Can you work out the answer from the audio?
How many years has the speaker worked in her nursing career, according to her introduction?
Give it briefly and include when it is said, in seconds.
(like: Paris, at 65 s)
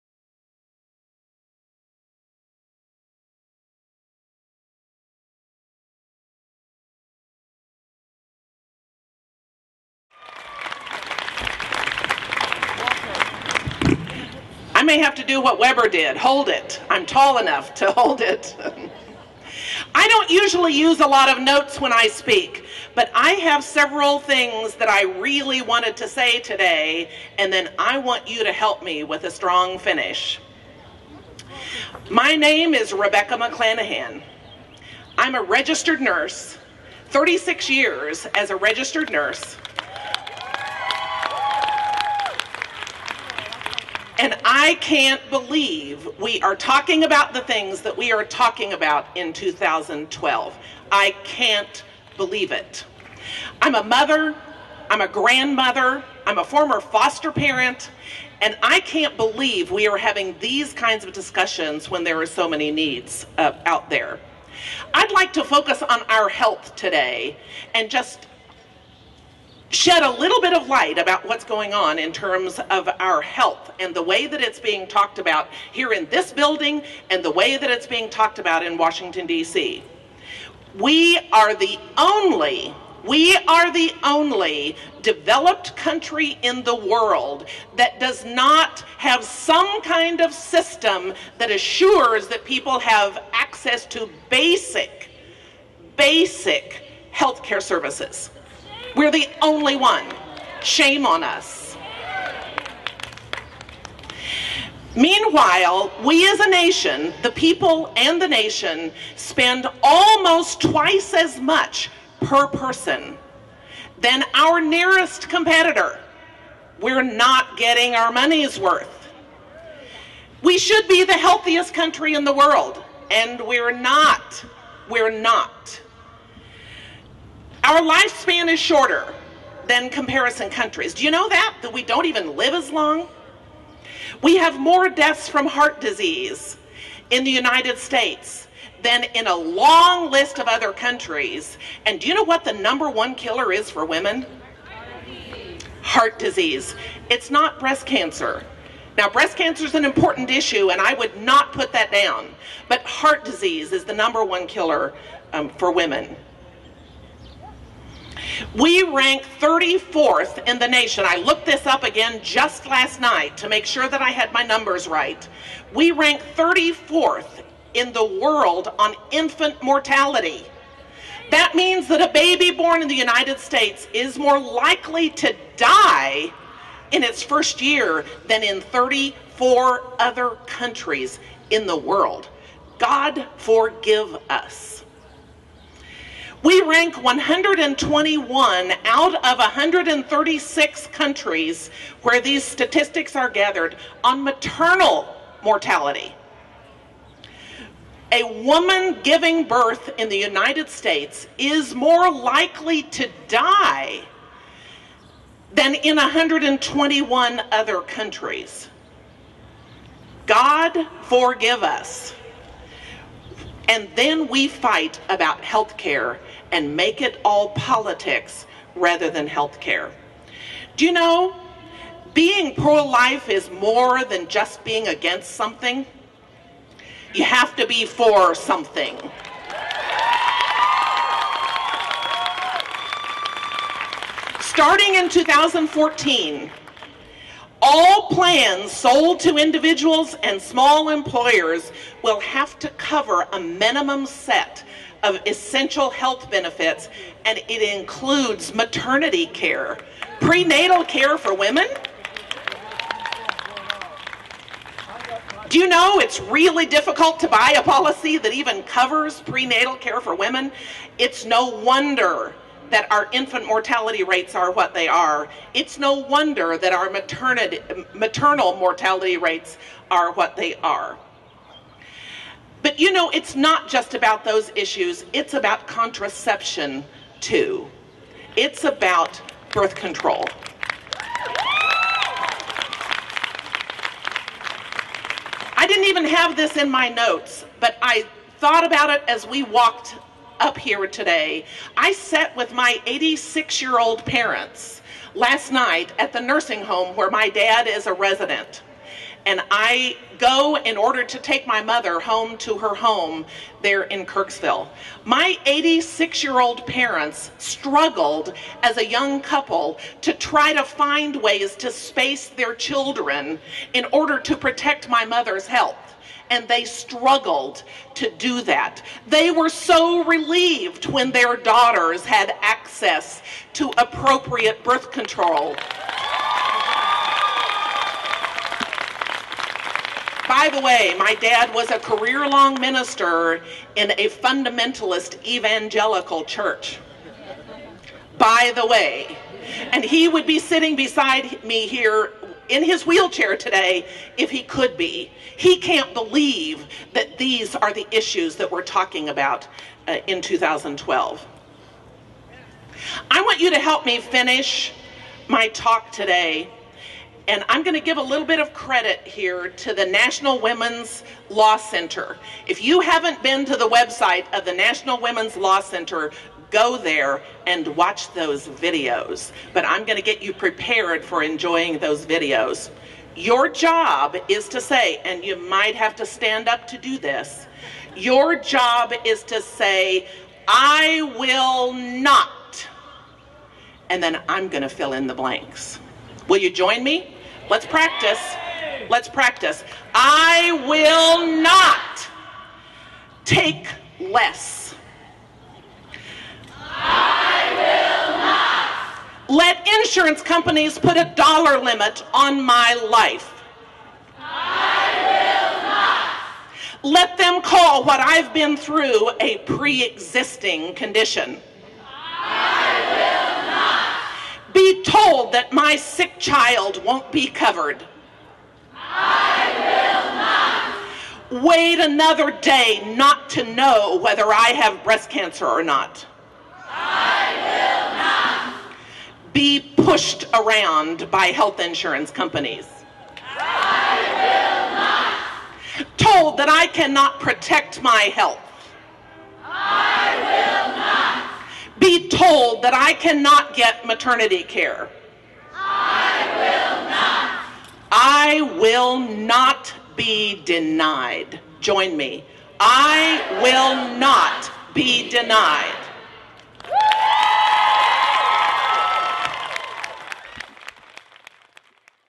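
36, at 37 s.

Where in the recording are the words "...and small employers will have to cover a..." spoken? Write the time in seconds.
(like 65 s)
240 s.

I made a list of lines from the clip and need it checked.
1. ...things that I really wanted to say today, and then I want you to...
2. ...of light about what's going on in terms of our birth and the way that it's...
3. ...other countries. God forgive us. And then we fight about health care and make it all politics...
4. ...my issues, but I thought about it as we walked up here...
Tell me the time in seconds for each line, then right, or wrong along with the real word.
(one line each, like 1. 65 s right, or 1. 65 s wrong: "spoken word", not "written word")
1. 24 s right
2. 70 s wrong: "health", not "birth"
3. 207 s right
4. 286 s wrong: "notes", not "issues".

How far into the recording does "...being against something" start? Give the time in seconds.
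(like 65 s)
224 s.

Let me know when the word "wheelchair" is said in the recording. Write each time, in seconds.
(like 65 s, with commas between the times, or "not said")
342 s.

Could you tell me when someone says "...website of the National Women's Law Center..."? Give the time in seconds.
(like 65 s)
363 s.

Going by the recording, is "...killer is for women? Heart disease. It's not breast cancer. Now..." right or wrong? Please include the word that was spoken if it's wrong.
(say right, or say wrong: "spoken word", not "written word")
right.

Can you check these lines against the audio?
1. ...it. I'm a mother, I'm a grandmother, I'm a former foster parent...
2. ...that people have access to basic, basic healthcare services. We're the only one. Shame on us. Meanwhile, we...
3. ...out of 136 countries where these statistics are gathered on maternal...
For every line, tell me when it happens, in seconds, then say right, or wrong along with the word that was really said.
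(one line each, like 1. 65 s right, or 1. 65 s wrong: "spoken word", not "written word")
1. 52 s right
2. 92 s right
3. 188 s right.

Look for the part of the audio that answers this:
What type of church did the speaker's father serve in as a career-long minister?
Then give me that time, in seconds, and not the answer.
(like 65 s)
334 s.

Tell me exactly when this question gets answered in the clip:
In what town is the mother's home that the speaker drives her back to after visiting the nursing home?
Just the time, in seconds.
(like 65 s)
304 s.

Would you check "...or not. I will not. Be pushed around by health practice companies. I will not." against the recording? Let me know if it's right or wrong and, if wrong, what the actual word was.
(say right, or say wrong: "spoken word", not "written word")
wrong: "insurance", not "practice".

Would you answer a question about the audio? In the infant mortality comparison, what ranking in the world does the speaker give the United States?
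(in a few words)
34th.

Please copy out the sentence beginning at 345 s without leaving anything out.
He can't believe that these are the issues that we're talking about uh, in 2012.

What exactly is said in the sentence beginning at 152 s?
But heart disease is the number one killer um, for women.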